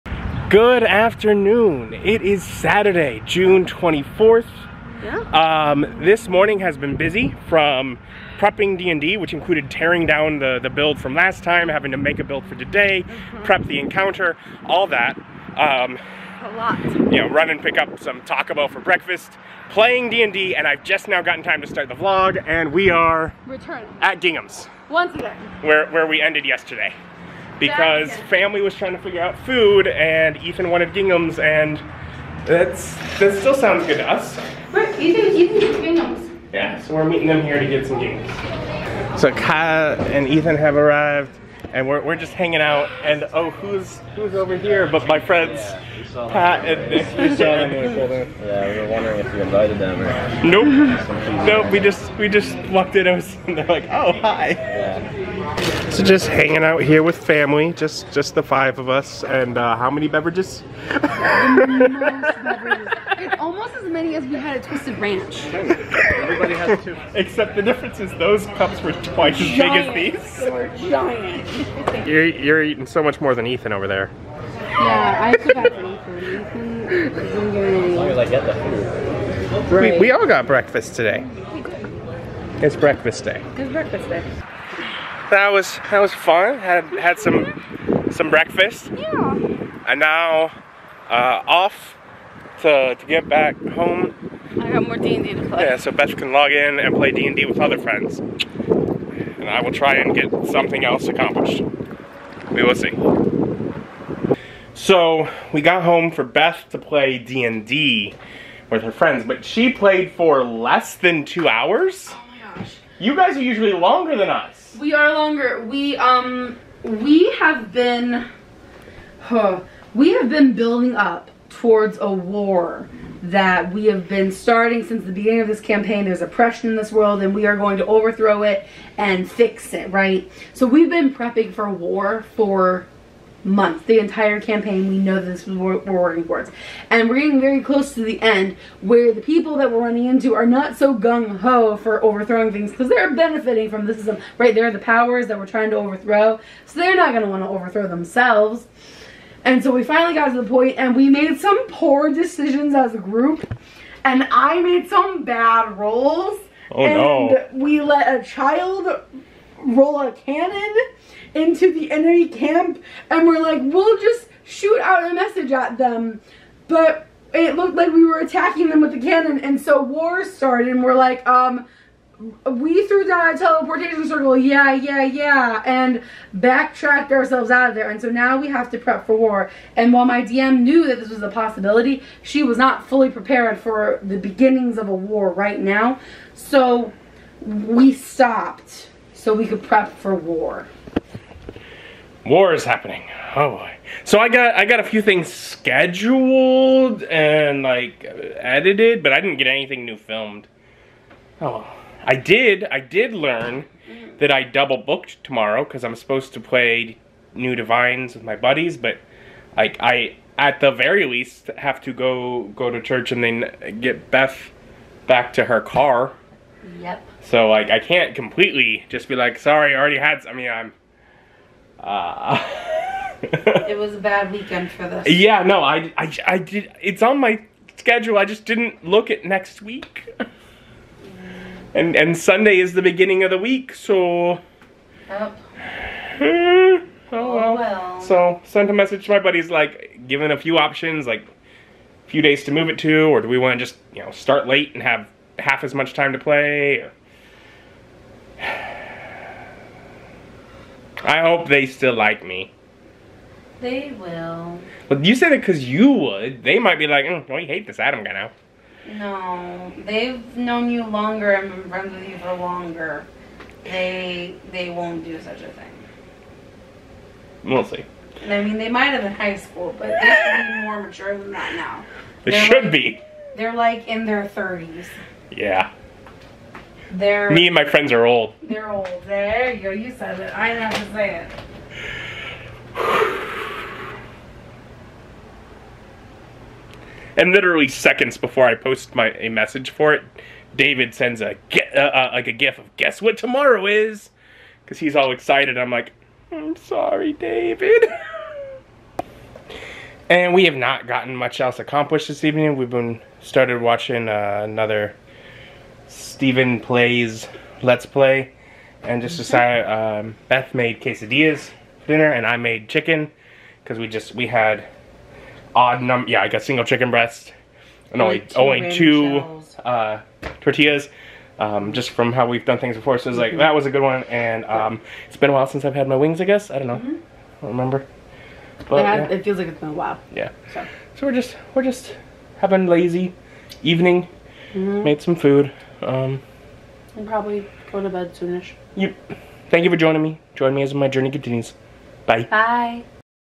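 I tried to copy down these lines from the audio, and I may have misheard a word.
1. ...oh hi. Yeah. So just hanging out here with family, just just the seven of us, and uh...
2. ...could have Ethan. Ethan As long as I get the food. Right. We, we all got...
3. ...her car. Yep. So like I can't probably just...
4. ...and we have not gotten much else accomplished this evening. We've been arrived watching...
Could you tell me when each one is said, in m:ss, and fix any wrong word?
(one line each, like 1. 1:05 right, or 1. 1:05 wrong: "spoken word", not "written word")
1. 0:53 wrong: "five", not "seven"
2. 1:15 right
3. 3:35 wrong: "completely", not "probably"
4. 5:00 wrong: "started", not "arrived".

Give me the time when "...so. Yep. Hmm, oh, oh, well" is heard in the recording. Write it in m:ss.
3:53.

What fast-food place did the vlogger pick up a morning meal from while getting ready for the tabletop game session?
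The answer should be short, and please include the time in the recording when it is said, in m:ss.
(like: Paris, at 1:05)
Taco Bell, at 0:18.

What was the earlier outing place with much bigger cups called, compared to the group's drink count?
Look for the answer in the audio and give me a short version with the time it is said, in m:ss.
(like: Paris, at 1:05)
Twisted Ranch, at 1:04.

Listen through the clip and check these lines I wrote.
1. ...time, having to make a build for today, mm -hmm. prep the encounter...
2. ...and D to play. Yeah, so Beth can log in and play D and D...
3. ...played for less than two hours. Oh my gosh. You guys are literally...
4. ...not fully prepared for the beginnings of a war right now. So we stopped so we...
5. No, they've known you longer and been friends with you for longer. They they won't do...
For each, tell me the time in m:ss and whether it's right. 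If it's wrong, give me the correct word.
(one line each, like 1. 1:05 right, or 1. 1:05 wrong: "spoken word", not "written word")
1. 0:11 right
2. 1:35 right
3. 1:49 wrong: "usually", not "literally"
4. 3:02 right
5. 4:18 right.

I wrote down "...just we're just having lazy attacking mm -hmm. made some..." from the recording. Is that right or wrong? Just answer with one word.
wrong.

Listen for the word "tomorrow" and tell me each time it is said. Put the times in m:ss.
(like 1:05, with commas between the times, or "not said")
3:25, 4:53.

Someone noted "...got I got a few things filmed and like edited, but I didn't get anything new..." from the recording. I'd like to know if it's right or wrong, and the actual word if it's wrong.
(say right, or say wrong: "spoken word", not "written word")
wrong: "scheduled", not "filmed".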